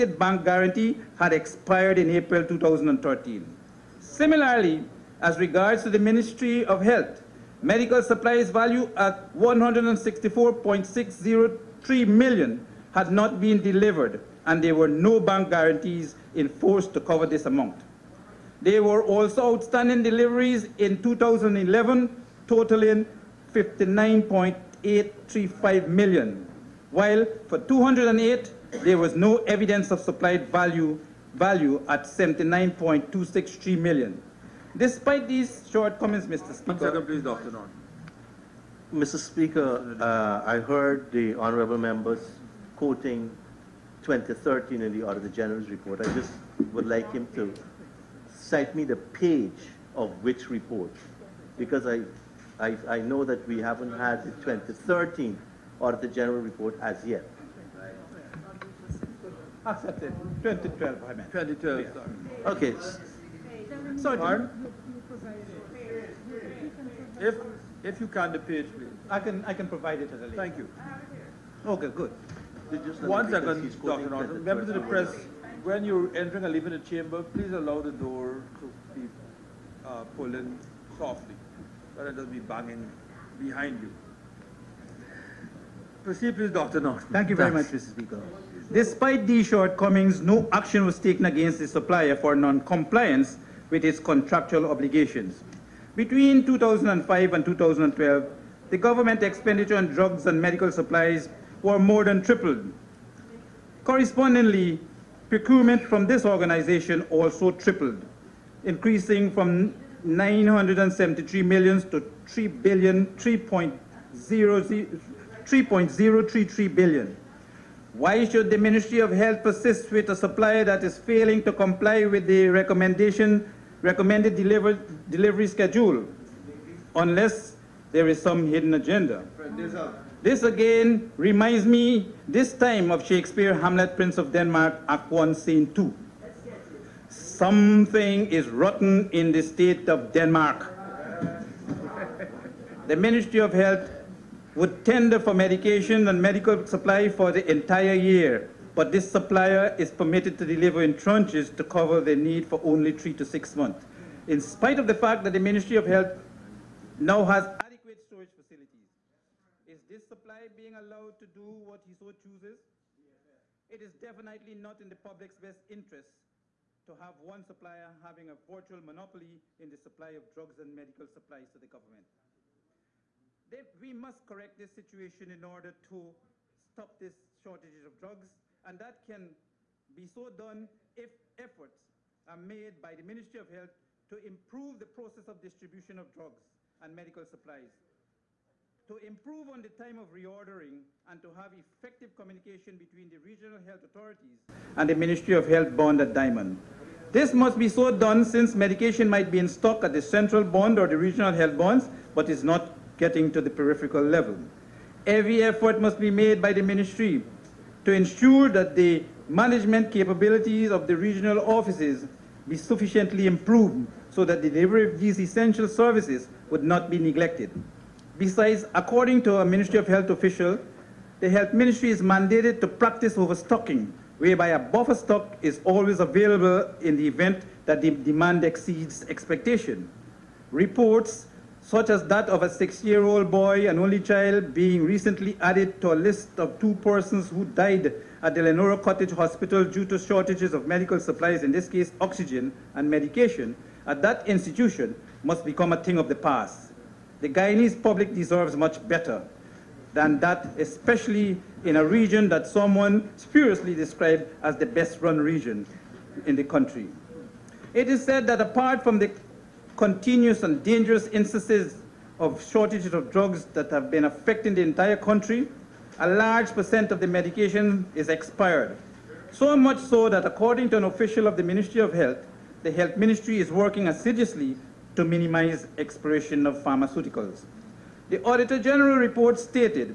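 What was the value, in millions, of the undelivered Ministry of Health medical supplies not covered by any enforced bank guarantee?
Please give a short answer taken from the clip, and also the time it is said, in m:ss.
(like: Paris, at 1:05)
164.603 million, at 0:09.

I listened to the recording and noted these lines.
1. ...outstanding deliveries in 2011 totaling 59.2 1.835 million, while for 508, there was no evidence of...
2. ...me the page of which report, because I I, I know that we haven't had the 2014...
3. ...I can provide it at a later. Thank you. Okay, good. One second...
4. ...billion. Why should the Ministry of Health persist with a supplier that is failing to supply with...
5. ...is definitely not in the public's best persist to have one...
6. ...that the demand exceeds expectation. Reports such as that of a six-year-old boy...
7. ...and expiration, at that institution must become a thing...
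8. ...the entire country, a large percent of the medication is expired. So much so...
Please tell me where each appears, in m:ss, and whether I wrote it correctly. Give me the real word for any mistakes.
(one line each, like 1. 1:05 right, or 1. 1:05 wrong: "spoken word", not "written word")
1. 0:19 wrong: "208", not "508"
2. 0:48 wrong: "2013", not "2014"
3. 1:09 right
4. 1:56 wrong: "comply", not "supply"
5. 2:43 wrong: "interest", not "persist"
6. 3:47 right
7. 4:02 wrong: "medication", not "expiration"
8. 4:24 right.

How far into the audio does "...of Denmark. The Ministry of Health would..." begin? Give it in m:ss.
2:19.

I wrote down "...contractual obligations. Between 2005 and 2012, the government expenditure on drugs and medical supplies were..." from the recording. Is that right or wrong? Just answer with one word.
right.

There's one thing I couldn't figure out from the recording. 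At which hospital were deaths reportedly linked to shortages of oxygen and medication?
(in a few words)
Leonora Cottage Hospital.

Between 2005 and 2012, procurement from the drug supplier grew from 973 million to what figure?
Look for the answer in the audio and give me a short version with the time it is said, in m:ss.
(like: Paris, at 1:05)
3.033 billion, at 1:53.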